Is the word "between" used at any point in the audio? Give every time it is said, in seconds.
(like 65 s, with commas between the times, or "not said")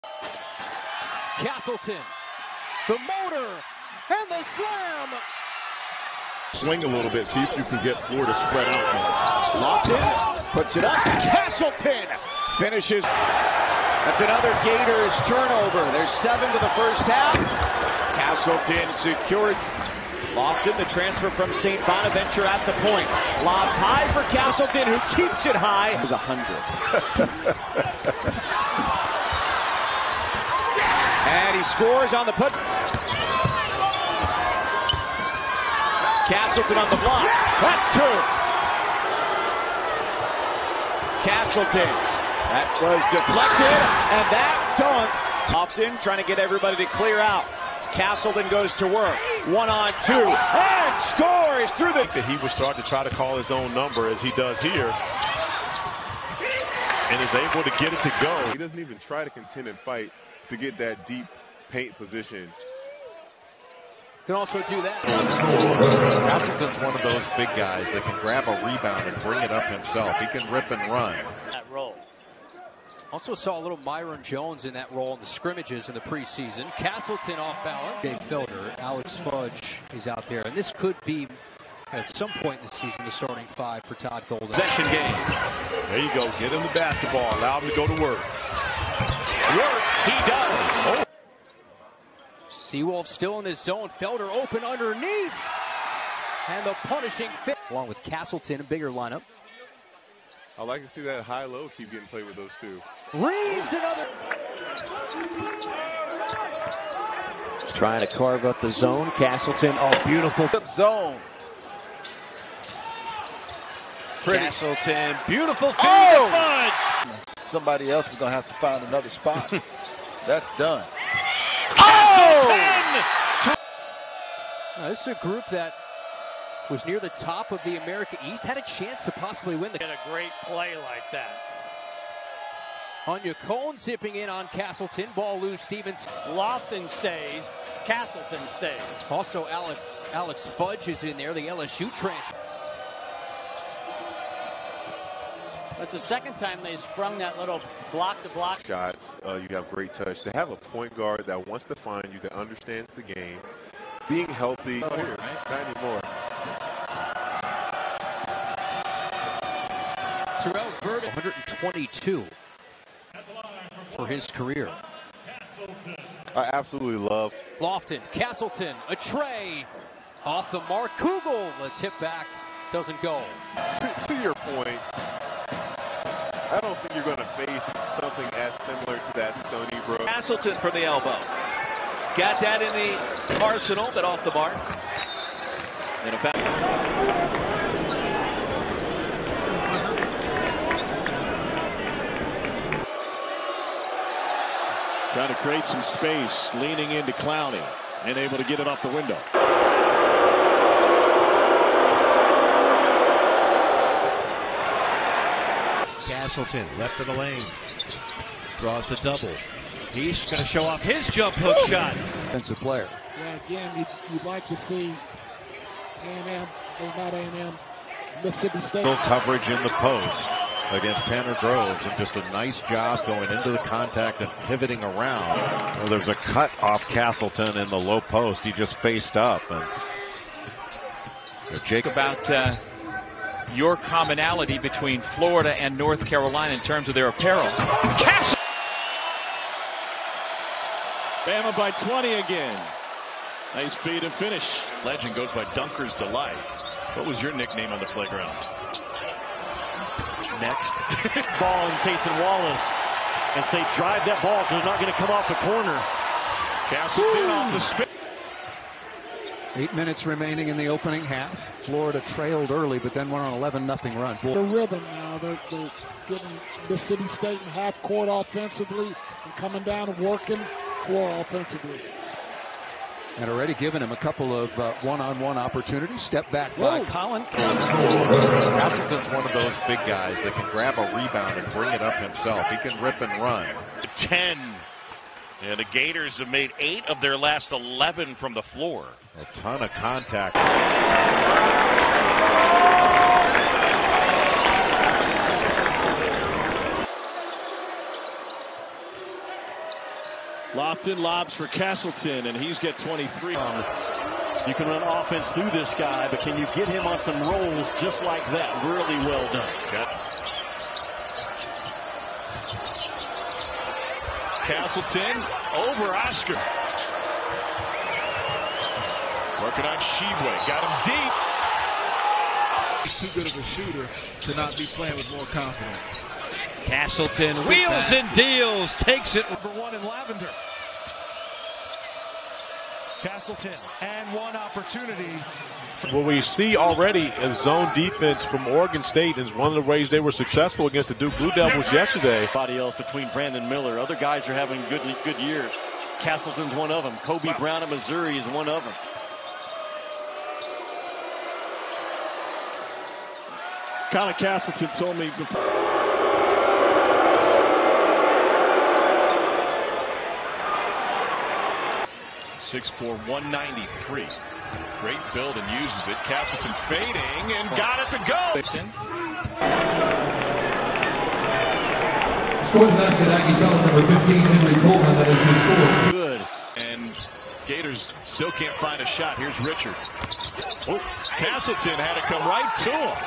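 234 s, 342 s.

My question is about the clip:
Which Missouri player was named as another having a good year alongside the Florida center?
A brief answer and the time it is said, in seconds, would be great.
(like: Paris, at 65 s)
Kobe Brown, at 346 s.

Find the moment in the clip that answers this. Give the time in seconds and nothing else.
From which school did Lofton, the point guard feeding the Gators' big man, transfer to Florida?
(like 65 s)
21 s.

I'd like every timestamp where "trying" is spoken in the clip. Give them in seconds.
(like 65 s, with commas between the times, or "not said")
46 s, 107 s, 195 s.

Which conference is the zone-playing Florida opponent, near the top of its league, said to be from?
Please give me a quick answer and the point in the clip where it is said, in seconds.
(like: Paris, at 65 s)
America East, at 127 s.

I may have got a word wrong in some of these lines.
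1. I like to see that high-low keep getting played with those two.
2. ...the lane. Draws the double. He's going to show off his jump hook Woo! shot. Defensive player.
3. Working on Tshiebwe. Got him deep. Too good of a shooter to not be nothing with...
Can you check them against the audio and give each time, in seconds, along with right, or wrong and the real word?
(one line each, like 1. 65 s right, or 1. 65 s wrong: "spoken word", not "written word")
1. 100 s right
2. 207 s right
3. 319 s wrong: "playing", not "nothing".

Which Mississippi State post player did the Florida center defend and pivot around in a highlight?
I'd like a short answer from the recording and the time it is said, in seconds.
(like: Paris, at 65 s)
Tanner Groves, at 221 s.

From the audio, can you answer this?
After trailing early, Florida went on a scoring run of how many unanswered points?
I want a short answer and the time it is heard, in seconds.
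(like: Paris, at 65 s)
11, at 263 s.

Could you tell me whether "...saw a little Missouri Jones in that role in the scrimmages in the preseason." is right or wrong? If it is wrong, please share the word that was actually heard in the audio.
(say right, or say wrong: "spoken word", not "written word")
wrong: "Myreon", not "Missouri".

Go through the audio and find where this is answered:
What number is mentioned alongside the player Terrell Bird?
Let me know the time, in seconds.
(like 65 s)
161 s.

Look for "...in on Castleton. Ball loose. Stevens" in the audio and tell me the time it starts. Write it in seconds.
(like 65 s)
134 s.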